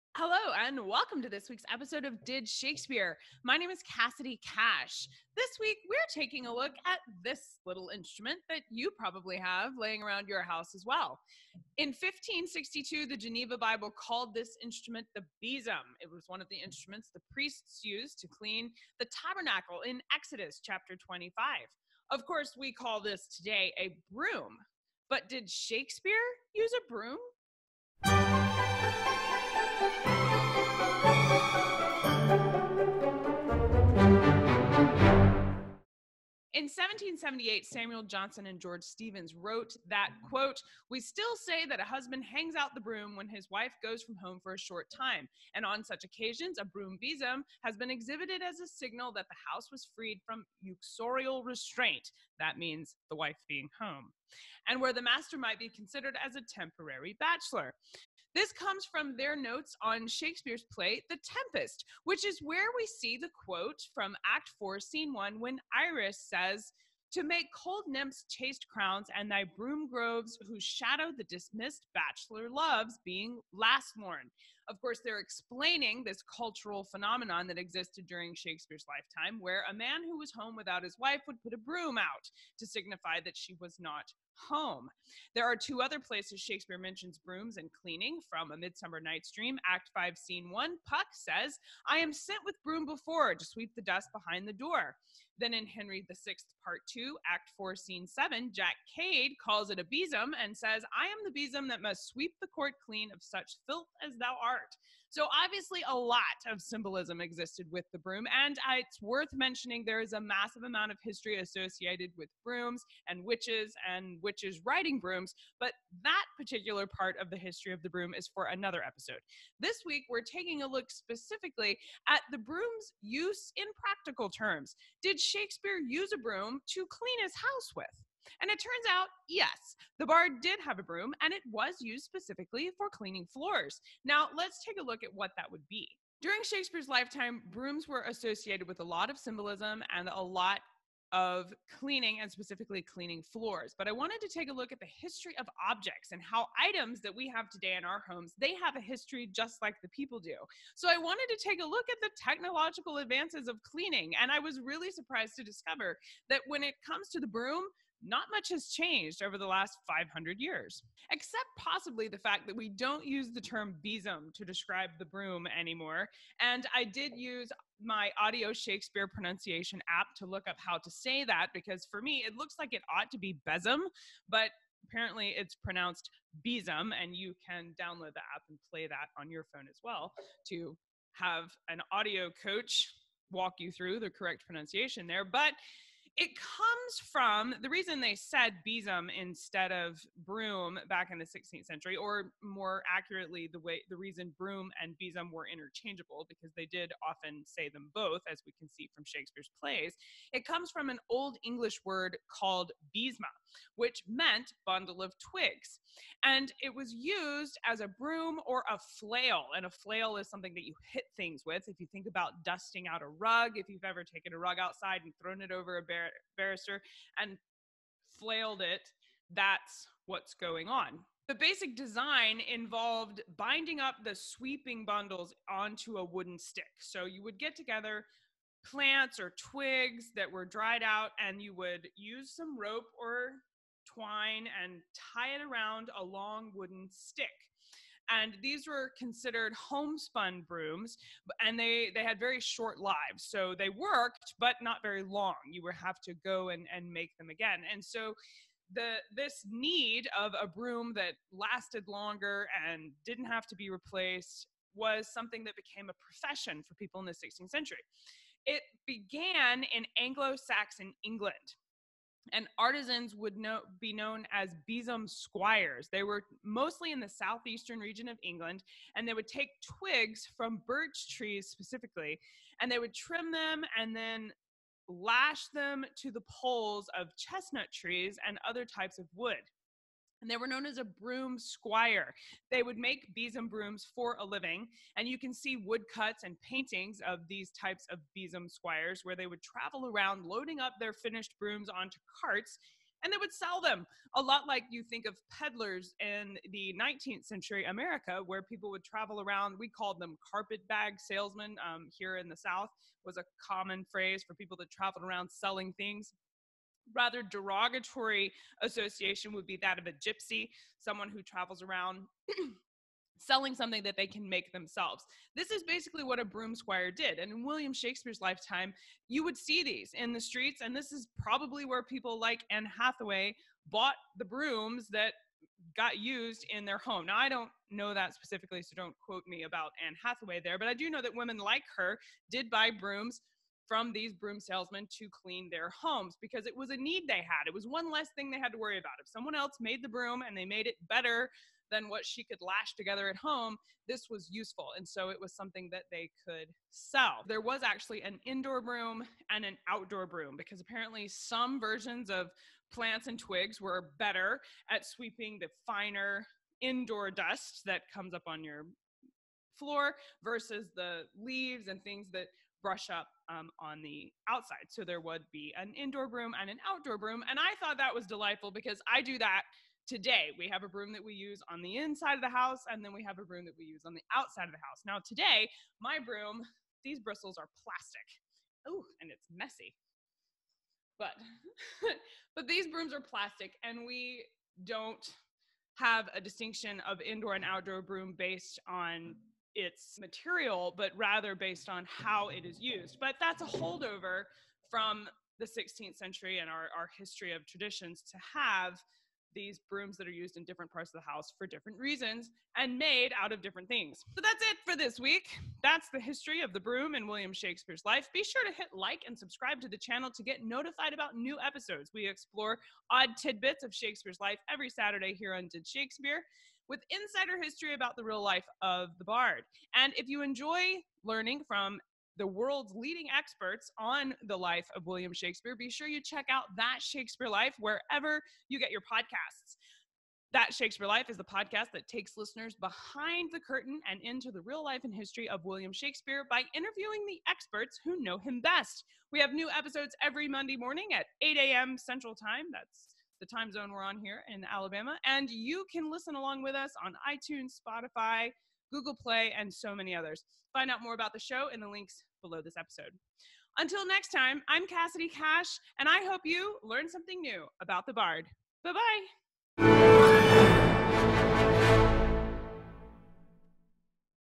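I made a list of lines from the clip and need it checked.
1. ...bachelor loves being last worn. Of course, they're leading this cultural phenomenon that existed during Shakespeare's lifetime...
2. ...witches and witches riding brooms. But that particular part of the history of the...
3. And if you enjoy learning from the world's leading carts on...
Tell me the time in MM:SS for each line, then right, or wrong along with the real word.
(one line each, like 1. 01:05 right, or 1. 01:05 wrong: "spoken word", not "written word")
1. 01:11 wrong: "explaining", not "leading"
2. 01:53 right
3. 06:59 wrong: "experts", not "carts".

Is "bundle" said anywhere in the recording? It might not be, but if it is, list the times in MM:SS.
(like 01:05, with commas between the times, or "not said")
03:24, 03:44.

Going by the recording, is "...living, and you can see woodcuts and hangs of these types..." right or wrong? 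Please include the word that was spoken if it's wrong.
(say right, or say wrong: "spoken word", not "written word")
wrong: "paintings", not "hangs".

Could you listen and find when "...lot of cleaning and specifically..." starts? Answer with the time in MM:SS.
02:20.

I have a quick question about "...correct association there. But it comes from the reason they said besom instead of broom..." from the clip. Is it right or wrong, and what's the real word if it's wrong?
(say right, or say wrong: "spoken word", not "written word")
wrong: "pronunciation", not "association".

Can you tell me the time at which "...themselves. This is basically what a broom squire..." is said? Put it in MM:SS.
05:14.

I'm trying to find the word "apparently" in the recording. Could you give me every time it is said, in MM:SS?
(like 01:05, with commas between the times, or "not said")
02:54, 05:50.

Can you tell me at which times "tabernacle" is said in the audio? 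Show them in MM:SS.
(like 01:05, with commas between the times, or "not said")
00:19.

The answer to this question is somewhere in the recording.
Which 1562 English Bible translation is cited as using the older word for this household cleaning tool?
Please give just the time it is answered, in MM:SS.
00:13.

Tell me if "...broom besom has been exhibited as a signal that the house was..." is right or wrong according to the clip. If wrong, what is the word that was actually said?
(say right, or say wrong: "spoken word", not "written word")
right.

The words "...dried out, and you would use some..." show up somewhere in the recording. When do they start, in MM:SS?
03:50.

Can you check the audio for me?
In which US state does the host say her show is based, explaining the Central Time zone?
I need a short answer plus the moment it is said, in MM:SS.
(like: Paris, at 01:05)
Alabama, at 07:24.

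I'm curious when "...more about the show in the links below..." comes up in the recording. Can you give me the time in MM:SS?
07:30.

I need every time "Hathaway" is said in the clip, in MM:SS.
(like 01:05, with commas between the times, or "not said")
05:22, 05:30.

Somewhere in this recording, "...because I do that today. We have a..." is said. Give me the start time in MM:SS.
06:08.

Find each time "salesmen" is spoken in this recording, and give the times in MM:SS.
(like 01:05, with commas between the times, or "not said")
05:00, 05:34.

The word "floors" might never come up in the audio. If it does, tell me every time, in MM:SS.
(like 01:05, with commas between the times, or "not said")
02:13, 02:23, 05:59.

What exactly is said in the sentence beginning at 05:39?
If someone else made the broom and they made it better than what she could lash together at home, this was useful.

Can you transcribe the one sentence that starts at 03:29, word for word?
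And a flail is something that you hit things with.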